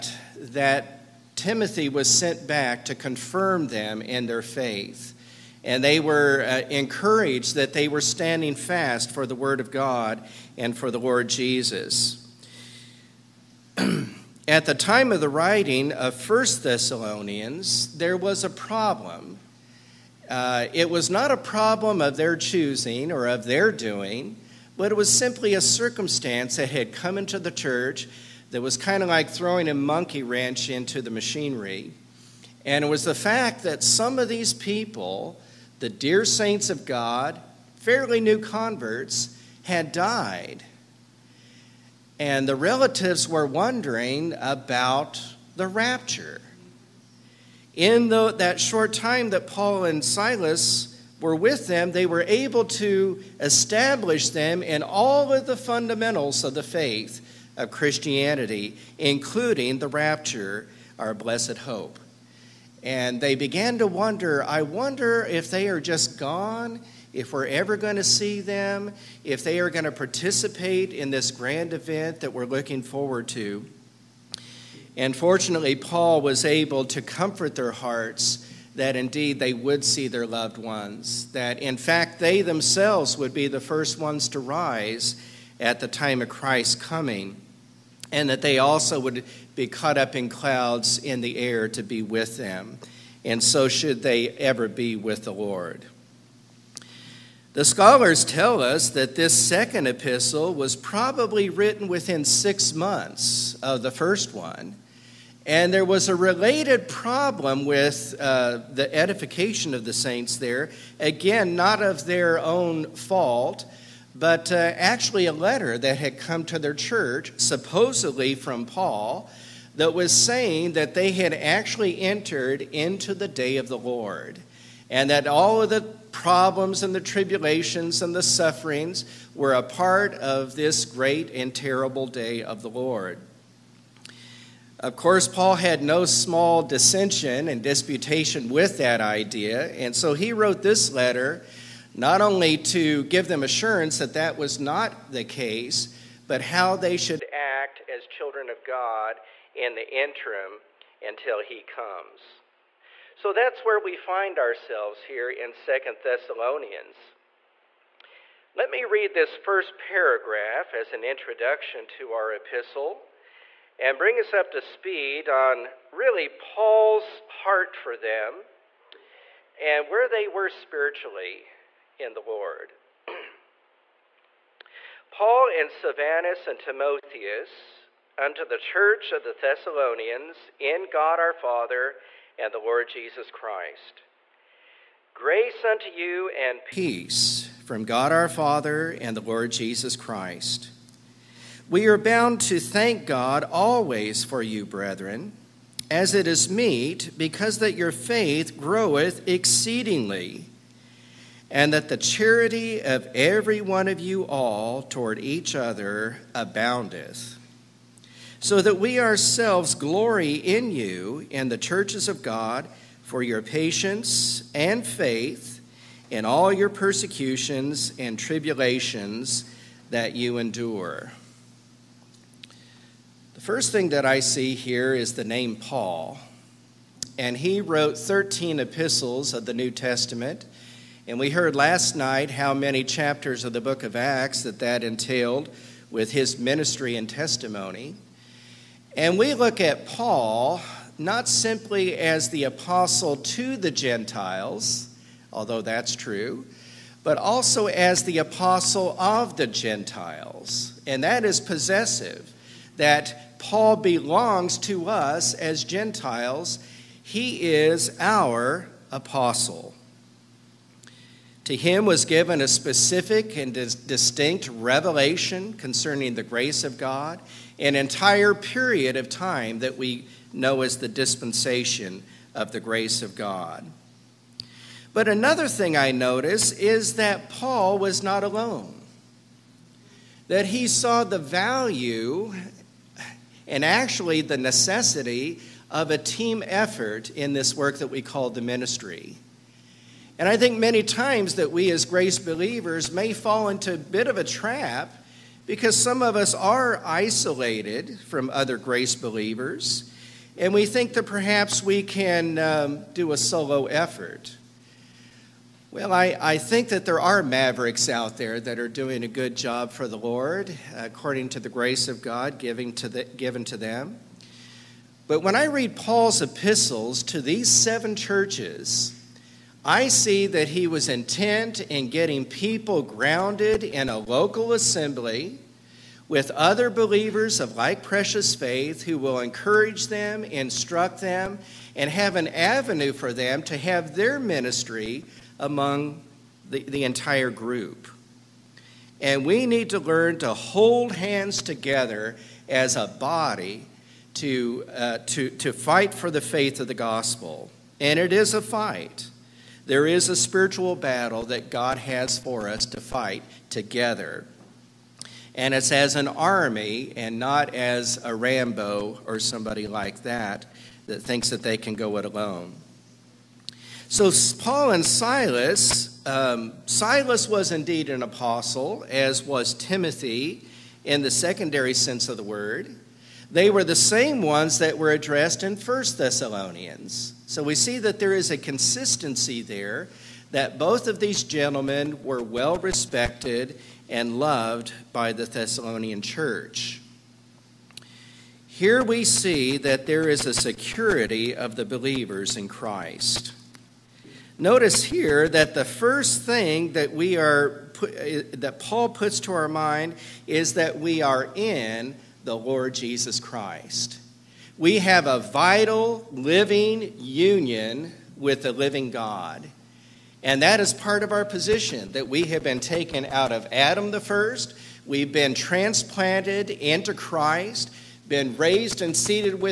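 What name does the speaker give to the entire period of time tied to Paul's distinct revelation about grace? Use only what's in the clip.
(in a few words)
dispensation of the grace of God.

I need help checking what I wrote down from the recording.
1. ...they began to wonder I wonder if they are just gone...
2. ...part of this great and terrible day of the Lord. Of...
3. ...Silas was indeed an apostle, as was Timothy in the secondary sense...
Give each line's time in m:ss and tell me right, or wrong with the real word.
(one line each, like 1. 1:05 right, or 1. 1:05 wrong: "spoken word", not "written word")
1. 1:03 right
2. 2:09 right
3. 6:06 right.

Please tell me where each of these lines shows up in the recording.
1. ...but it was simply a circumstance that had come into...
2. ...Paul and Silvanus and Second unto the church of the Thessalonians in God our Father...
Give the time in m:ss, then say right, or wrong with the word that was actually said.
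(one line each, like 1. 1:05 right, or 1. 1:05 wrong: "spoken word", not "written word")
1. 0:24 right
2. 2:55 wrong: "Timotheus", not "Second".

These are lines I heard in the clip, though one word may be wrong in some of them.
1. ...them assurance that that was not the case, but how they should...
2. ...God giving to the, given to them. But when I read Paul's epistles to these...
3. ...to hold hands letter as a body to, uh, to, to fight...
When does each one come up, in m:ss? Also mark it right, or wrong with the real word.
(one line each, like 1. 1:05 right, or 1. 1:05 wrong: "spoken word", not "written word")
1. 2:23 right
2. 5:12 right
3. 5:40 wrong: "together", not "letter".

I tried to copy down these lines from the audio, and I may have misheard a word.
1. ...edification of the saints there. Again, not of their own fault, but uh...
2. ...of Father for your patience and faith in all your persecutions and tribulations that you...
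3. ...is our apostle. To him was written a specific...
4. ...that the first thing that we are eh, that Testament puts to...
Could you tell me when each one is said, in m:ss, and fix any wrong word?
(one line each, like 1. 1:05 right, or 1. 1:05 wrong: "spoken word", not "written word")
1. 1:48 right
2. 3:32 wrong: "God", not "Father"
3. 4:17 wrong: "given", not "written"
4. 6:35 wrong: "Paul", not "Testament".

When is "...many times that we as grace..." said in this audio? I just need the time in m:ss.
4:50.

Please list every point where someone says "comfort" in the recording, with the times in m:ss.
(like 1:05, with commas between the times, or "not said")
1:17.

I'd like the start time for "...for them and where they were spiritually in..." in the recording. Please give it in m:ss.
2:47.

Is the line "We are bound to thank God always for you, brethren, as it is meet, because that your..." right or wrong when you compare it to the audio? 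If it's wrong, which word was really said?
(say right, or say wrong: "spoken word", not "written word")
right.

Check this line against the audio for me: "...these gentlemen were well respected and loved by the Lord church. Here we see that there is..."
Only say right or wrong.
wrong.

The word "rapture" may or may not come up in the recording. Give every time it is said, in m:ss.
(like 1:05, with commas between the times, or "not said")
0:45, 0:59.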